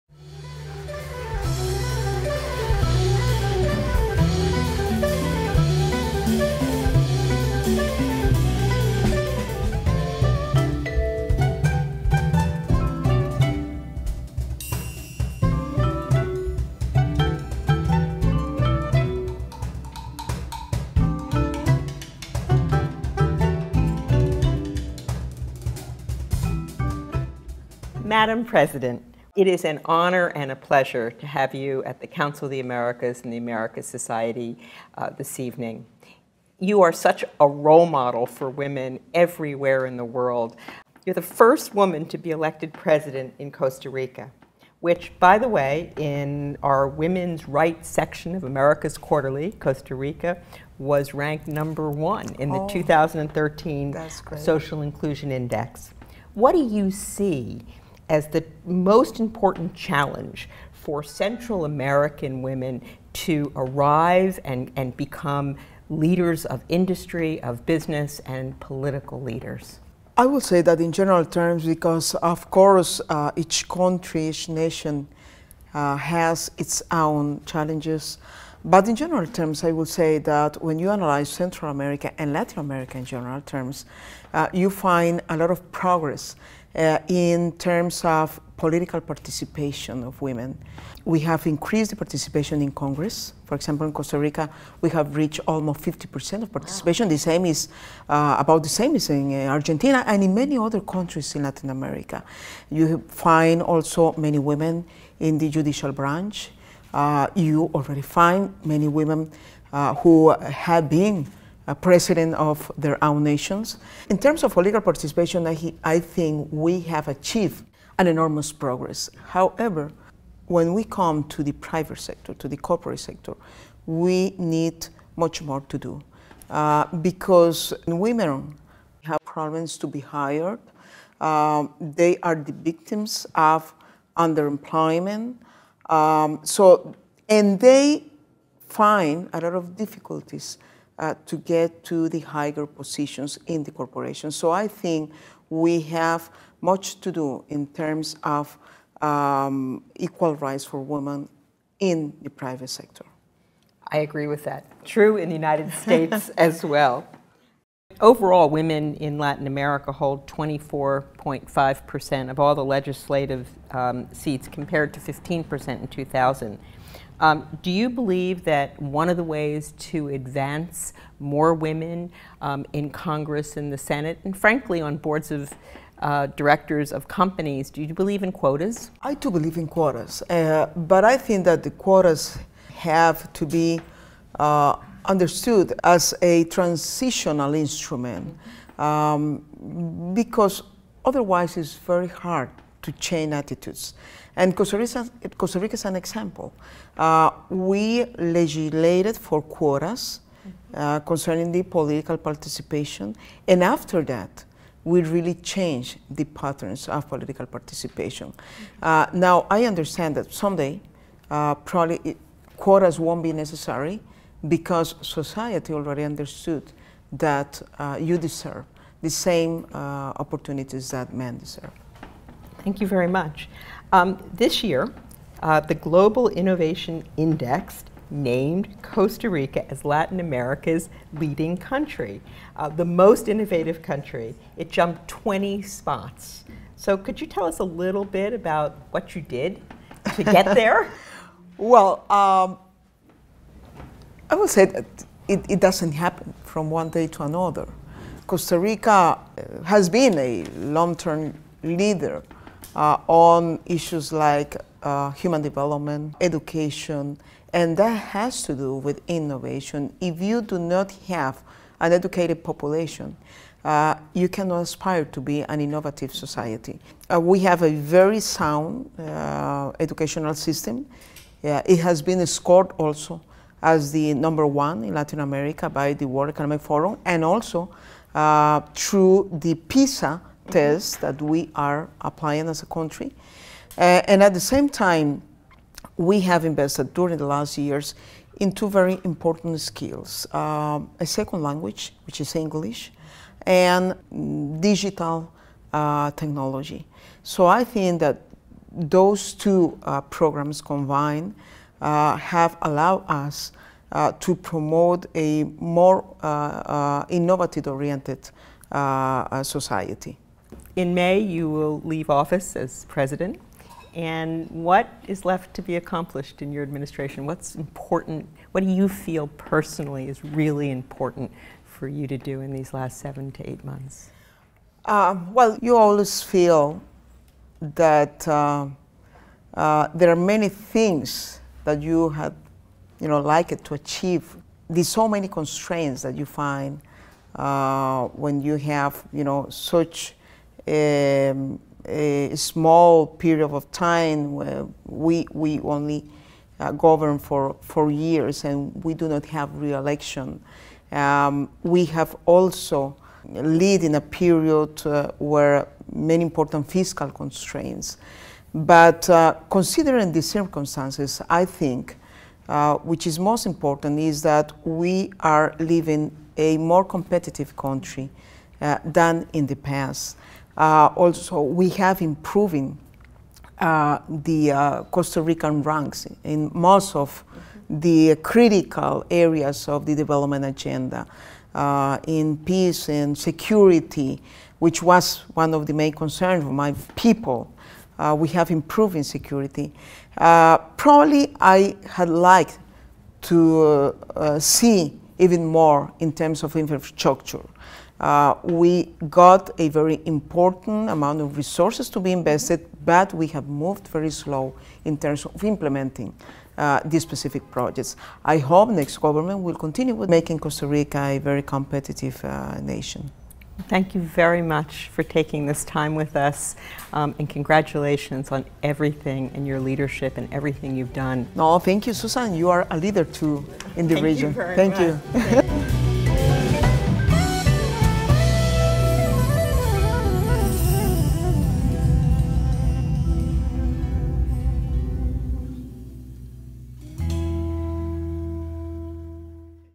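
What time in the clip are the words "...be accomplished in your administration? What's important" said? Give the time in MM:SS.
05:15.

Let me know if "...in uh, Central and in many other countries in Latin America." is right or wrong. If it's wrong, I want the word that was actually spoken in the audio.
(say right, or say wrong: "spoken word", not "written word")
wrong: "Argentina", not "Central".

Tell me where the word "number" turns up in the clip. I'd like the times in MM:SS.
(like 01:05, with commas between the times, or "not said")
00:51, 04:34.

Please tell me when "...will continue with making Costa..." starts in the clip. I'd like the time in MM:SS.
06:49.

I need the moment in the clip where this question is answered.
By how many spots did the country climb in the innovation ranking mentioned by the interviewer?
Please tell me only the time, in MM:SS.
03:55.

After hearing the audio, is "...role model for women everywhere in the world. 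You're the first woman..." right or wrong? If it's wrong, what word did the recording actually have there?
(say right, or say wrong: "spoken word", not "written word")
right.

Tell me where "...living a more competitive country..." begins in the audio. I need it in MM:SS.
06:05.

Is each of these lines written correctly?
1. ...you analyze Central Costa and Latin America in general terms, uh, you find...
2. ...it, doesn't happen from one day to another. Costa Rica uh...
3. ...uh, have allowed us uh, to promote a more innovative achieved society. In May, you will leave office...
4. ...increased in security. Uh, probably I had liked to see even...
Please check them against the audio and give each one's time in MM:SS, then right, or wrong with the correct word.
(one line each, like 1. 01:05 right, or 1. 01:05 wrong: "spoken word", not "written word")
1. 01:20 wrong: "America", not "Costa"
2. 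04:05 right
3. 05:01 wrong: "oriented", not "achieved"
4. 06:28 wrong: "improved", not "increased".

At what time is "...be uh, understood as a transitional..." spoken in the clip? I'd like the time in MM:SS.
03:03.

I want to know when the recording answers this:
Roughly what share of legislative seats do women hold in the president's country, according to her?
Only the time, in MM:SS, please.
01:35.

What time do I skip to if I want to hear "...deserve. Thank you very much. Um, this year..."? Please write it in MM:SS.
03:41.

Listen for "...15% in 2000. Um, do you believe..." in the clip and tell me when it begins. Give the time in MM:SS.
02:44.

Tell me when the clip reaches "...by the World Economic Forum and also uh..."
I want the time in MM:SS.
04:35.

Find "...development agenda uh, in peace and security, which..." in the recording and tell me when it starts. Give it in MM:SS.
06:19.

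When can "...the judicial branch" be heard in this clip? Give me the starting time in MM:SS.
01:45.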